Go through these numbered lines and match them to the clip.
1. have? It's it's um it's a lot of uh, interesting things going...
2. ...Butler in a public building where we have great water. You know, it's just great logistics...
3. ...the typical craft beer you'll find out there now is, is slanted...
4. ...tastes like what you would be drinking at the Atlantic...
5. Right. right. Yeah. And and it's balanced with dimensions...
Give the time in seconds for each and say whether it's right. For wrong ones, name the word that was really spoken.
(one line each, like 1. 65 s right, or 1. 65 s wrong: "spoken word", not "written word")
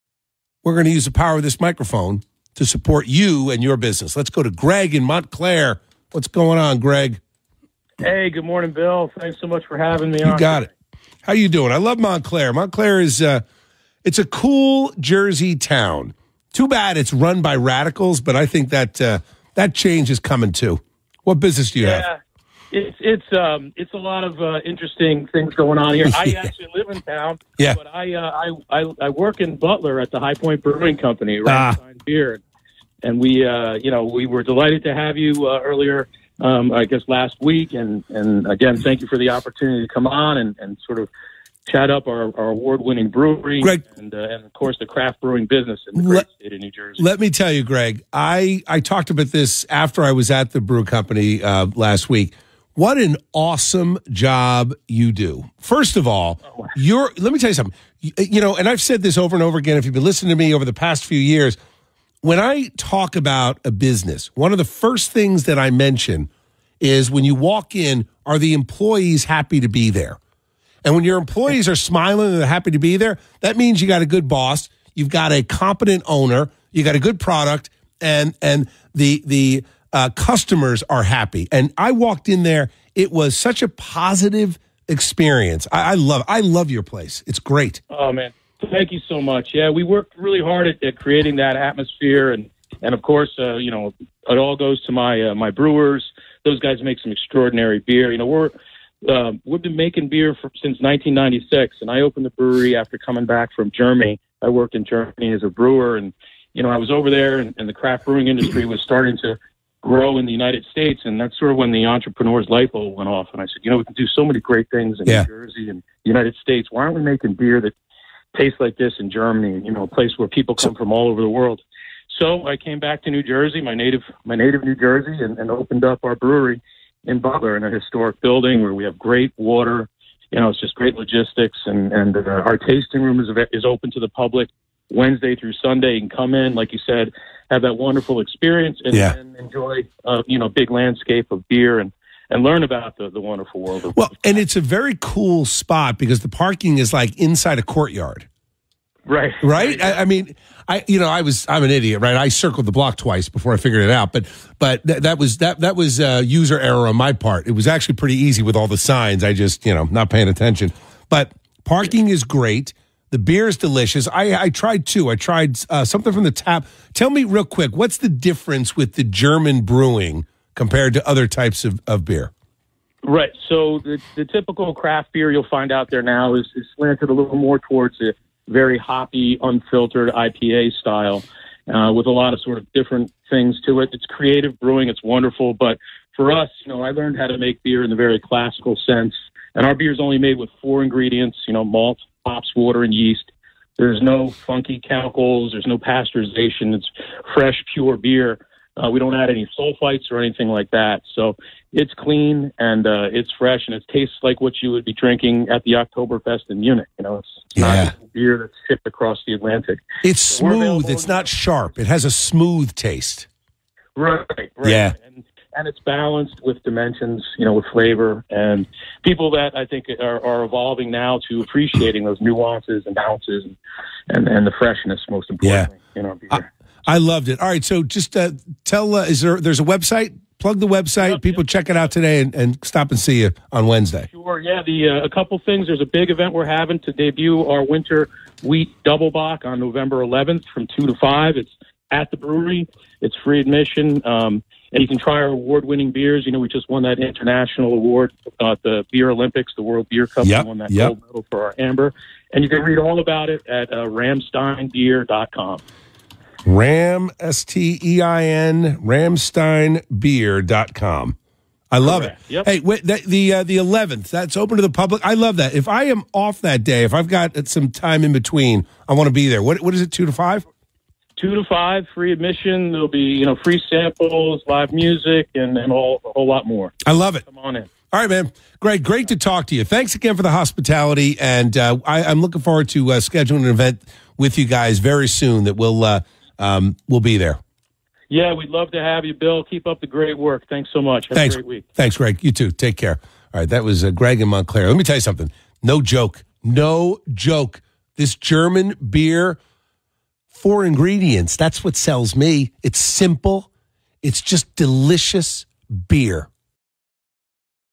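1. 22 s right
2. 127 s wrong: "historic", not "public"
3. 174 s right
4. 203 s wrong: "Oktoberfest", not "Atlantic"
5. 213 s right.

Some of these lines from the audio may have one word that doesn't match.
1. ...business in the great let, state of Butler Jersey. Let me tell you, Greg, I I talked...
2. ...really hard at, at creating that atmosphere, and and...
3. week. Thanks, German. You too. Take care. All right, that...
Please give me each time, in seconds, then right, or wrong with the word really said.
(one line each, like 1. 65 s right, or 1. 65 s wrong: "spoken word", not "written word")
1. 45 s wrong: "New", not "Butler"
2. 90 s right
3. 291 s wrong: "Greg", not "German".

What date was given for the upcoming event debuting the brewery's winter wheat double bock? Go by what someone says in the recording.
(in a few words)
November 11th.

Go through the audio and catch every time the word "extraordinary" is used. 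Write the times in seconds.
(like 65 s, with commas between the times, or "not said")
97 s.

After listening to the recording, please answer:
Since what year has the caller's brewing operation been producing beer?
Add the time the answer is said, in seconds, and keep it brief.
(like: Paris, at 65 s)
1996, at 100 s.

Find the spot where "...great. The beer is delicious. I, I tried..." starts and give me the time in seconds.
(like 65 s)
162 s.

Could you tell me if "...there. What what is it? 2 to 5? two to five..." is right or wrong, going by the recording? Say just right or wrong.
right.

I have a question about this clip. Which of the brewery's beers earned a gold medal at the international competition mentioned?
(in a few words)
amber.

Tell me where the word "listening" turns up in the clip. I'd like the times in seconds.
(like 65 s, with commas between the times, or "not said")
60 s.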